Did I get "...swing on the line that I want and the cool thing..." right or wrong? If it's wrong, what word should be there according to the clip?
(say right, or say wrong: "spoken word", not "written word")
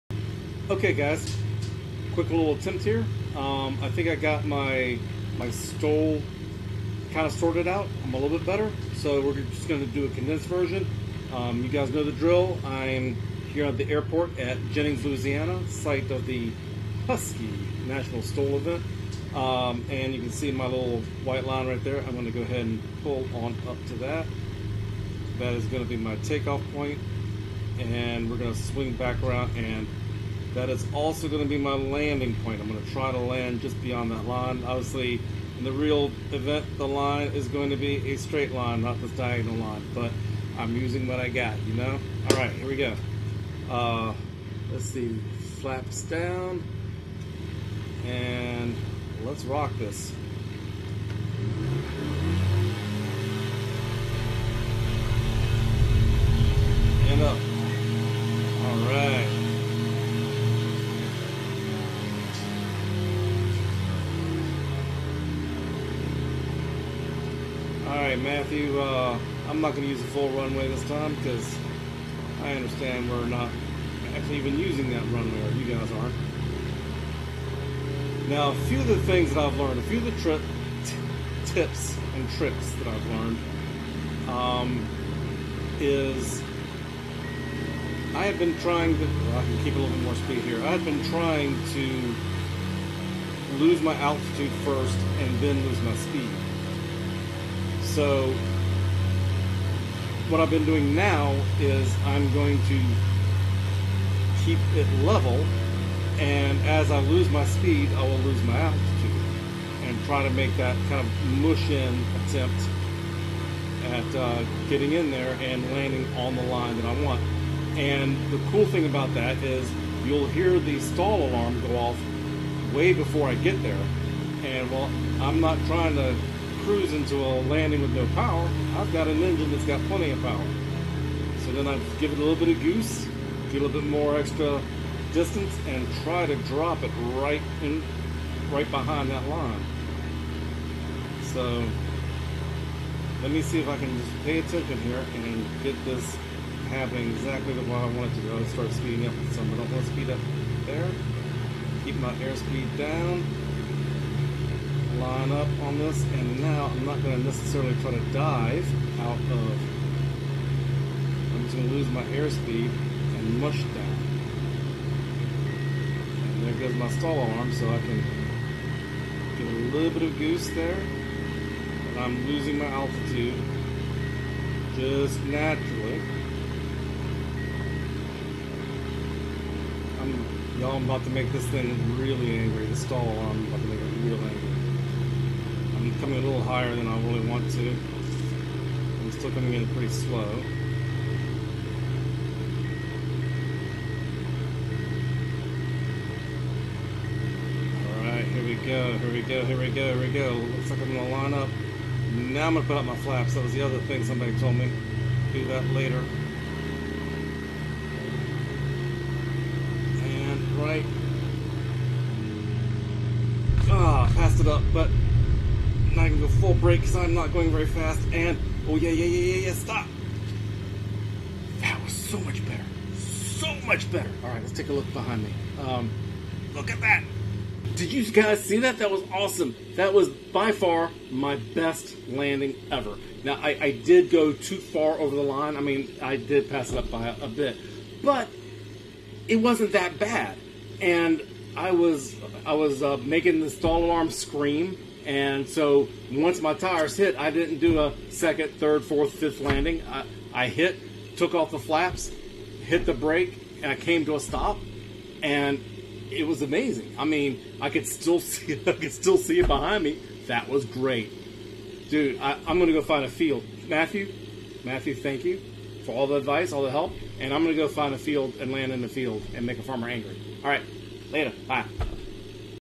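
wrong: "landing", not "swing".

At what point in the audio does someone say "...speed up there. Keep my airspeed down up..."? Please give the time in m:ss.
2:29.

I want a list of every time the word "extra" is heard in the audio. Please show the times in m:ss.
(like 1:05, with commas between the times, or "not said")
2:14.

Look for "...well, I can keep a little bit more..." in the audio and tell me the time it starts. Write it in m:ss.
1:29.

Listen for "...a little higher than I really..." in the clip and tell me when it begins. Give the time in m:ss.
3:06.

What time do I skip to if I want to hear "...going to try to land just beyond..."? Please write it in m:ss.
0:32.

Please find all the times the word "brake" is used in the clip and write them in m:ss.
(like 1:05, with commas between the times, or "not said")
3:36, 4:12.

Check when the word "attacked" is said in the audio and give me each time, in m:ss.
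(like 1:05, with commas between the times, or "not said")
not said.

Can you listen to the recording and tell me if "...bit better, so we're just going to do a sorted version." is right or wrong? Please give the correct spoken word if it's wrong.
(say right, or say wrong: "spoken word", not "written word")
wrong: "condensed", not "sorted".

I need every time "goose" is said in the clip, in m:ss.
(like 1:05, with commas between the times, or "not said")
2:12, 2:50.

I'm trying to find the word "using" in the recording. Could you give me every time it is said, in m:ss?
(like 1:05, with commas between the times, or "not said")
0:40, 1:14.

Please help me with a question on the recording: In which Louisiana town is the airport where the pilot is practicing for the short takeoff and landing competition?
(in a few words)
Jennings.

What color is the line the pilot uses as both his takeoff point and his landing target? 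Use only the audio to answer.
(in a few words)
White.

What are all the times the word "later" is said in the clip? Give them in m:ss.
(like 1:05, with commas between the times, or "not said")
3:25, 4:31.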